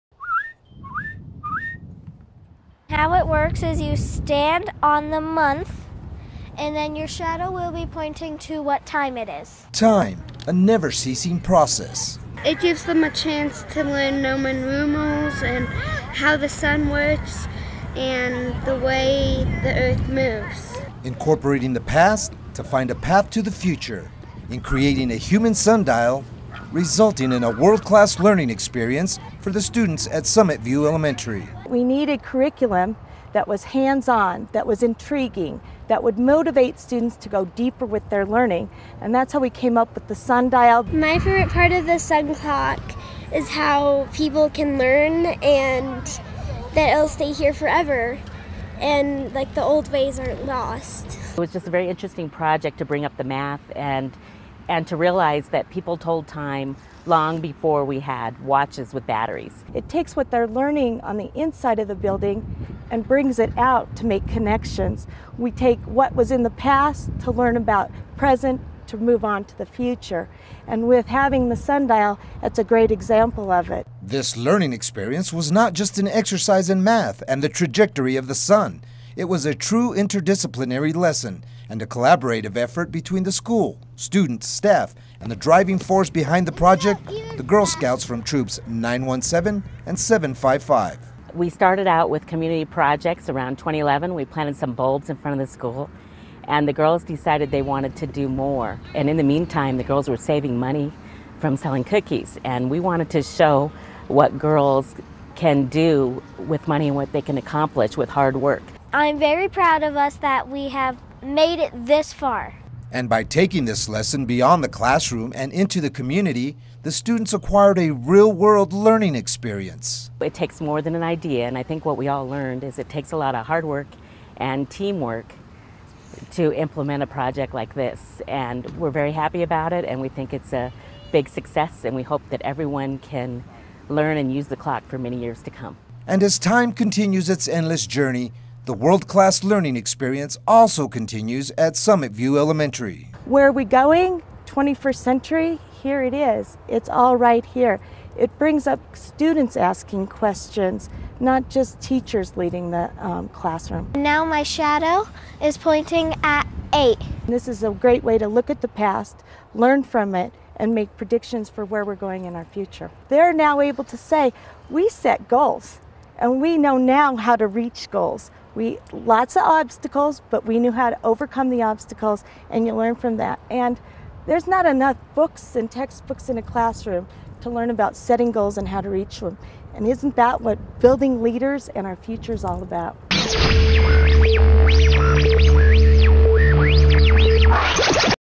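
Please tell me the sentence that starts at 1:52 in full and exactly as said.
And by taking this lesson beyond the classroom and into the community, the students acquired a real world learning experience.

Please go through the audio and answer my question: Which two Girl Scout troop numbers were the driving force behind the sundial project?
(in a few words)
917 and 755.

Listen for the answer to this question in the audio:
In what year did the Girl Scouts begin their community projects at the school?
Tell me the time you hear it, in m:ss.
1:33.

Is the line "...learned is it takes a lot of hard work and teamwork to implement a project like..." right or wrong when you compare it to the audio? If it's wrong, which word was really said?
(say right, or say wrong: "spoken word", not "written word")
right.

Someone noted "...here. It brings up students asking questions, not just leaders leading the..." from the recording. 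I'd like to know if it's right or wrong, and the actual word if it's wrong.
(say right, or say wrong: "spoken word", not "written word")
wrong: "teachers", not "leaders".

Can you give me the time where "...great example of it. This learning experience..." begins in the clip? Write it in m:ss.
1:12.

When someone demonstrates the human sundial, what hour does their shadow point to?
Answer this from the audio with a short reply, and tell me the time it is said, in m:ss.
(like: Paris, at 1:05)
8, at 2:36.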